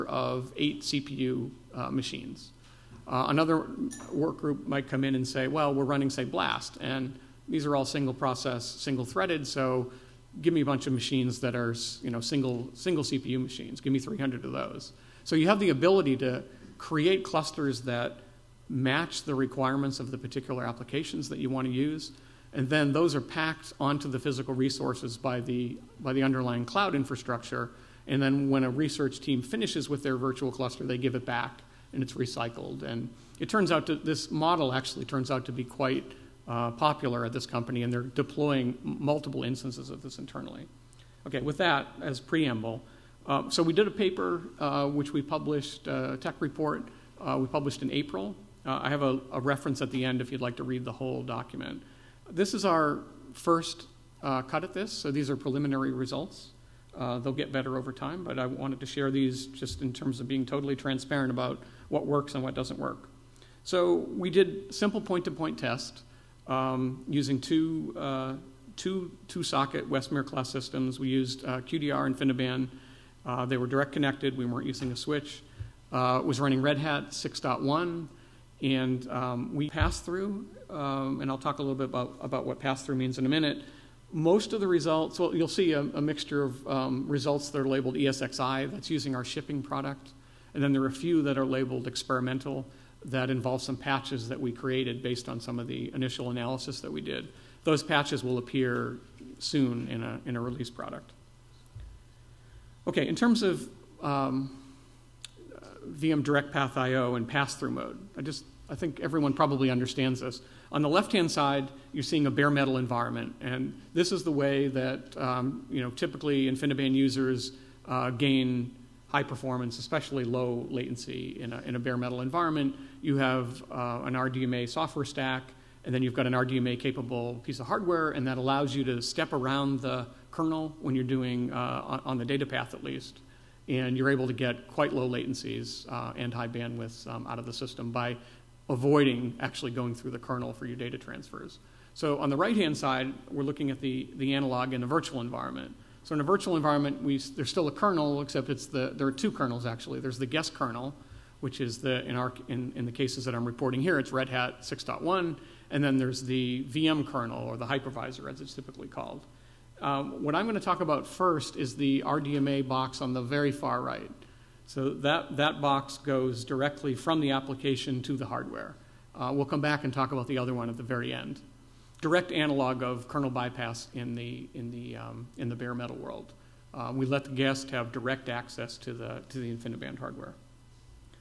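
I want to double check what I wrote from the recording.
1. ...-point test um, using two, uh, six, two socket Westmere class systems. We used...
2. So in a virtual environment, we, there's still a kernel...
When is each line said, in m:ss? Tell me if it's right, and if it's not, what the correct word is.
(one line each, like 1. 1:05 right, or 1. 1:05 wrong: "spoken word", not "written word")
1. 1:05 wrong: "two", not "six"
2. 2:26 right.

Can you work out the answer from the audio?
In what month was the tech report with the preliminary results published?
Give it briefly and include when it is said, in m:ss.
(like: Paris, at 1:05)
April, at 0:47.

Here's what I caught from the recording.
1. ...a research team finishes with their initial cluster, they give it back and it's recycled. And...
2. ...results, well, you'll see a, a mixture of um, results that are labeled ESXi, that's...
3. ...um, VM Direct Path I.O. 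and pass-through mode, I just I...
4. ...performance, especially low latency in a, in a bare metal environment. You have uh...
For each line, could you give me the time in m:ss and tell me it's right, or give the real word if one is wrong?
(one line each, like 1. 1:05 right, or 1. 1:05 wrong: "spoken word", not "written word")
1. 0:28 wrong: "virtual", not "initial"
2. 1:24 right
3. 1:44 right
4. 1:59 right.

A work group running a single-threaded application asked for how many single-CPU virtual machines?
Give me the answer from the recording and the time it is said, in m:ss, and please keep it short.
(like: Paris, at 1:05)
300, at 0:13.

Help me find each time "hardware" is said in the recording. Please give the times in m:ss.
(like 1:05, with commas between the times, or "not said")
2:07, 2:48, 2:59.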